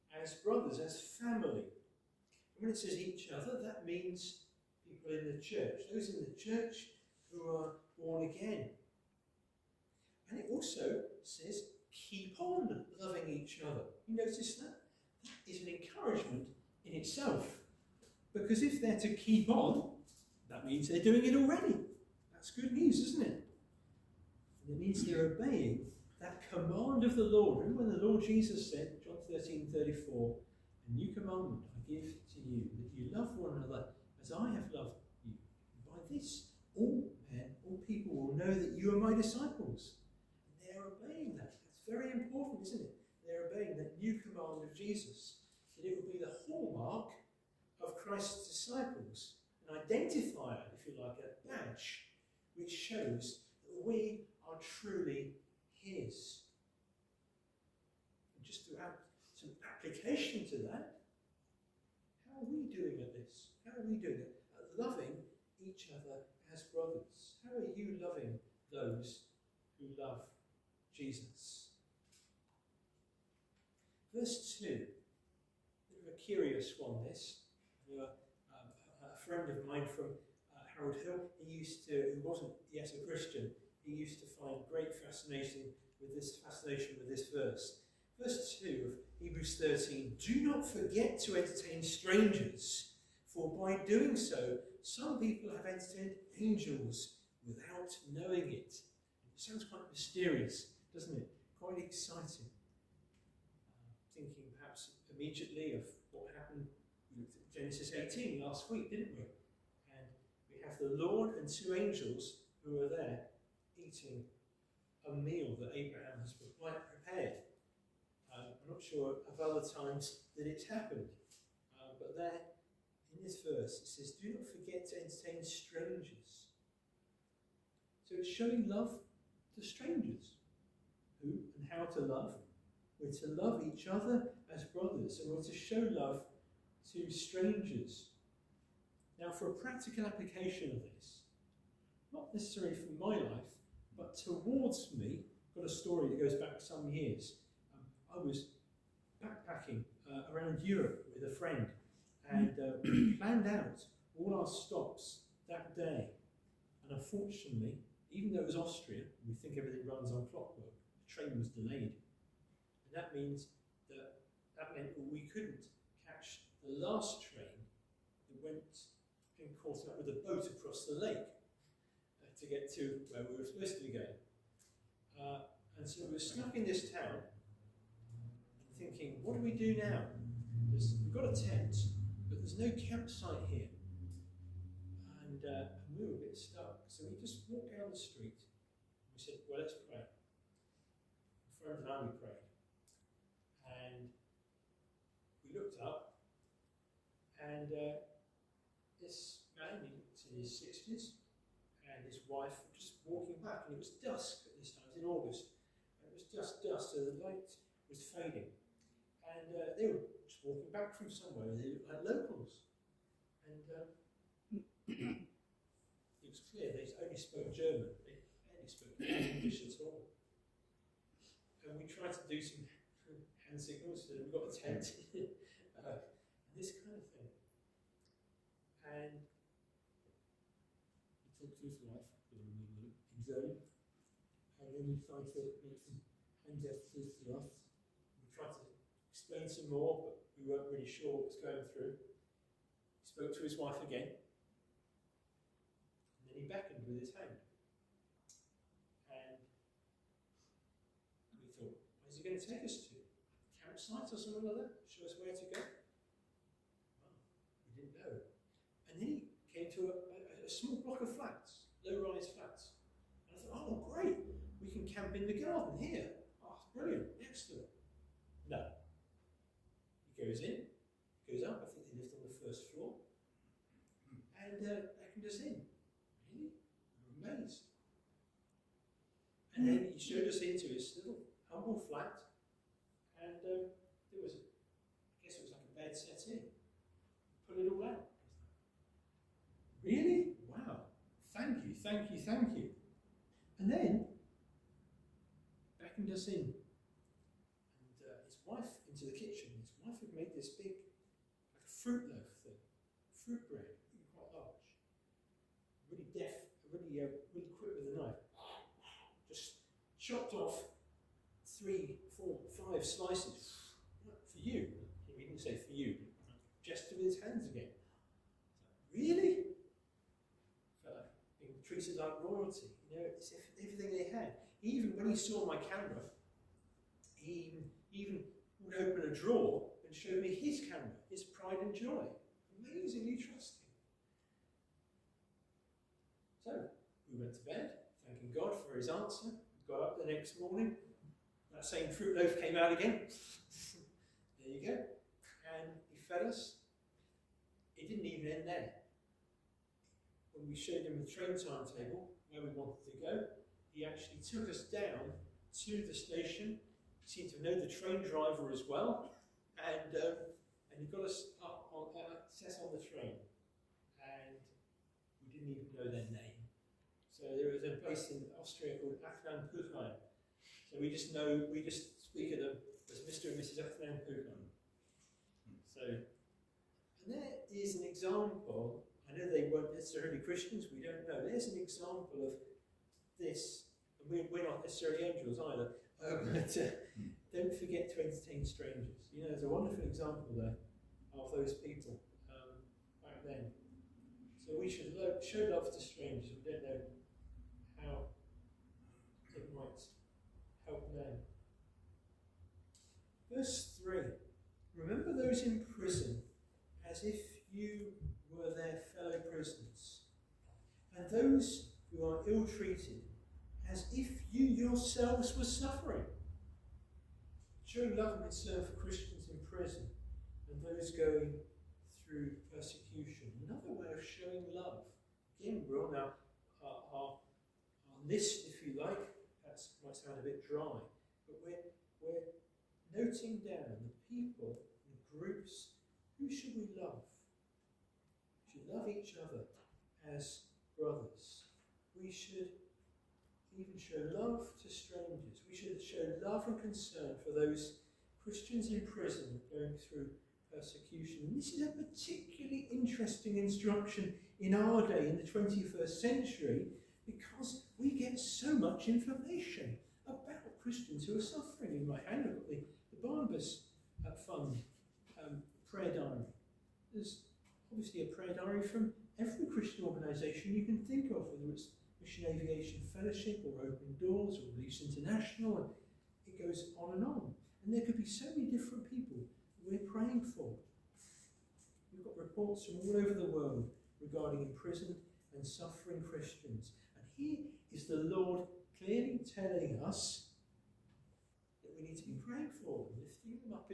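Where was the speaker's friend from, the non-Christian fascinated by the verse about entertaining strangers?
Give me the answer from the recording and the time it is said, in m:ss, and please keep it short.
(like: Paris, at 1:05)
Harold Hill, at 1:20.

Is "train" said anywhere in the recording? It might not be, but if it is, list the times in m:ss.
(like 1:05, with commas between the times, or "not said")
2:41, 2:47, 5:51, 5:57, 6:02.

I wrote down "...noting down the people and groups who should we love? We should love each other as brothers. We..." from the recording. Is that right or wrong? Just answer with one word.
right.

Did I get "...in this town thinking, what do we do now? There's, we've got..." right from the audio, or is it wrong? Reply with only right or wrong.
right.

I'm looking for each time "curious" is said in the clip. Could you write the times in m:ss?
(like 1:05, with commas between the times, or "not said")
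1:16.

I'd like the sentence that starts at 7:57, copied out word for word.
And there could be so many different people we're praying for.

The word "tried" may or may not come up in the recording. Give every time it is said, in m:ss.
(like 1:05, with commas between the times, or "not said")
3:41, 3:58.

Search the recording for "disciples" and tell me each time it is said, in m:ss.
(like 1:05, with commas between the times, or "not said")
0:39, 0:48.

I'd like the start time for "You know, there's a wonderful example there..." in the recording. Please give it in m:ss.
6:29.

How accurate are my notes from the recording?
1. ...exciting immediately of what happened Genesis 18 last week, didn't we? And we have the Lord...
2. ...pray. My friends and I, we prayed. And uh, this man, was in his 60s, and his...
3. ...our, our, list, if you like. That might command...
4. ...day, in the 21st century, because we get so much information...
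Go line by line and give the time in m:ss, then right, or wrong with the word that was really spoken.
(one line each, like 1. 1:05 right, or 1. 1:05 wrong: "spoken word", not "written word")
1. 1:41 right
2. 3:09 right
3. 7:06 wrong: "sound", not "command"
4. 7:34 right.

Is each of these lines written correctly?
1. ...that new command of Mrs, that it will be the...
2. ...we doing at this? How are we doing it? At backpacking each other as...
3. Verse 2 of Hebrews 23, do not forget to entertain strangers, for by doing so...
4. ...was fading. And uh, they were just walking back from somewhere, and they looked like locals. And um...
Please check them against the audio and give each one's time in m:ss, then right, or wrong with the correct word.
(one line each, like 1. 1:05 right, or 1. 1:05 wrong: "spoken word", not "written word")
1. 0:43 wrong: "Jesus", not "Mrs"
2. 1:02 wrong: "loving", not "backpacking"
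3. 1:28 wrong: "13", not "23"
4. 3:27 right.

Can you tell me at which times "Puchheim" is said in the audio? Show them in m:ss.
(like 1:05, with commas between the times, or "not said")
6:09, 6:13.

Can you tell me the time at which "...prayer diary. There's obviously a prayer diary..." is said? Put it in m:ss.
7:45.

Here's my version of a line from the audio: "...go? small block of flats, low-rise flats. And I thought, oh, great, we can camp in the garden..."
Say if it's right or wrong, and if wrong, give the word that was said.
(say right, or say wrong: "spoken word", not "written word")
right.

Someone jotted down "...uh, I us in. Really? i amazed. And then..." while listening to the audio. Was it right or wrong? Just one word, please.
right.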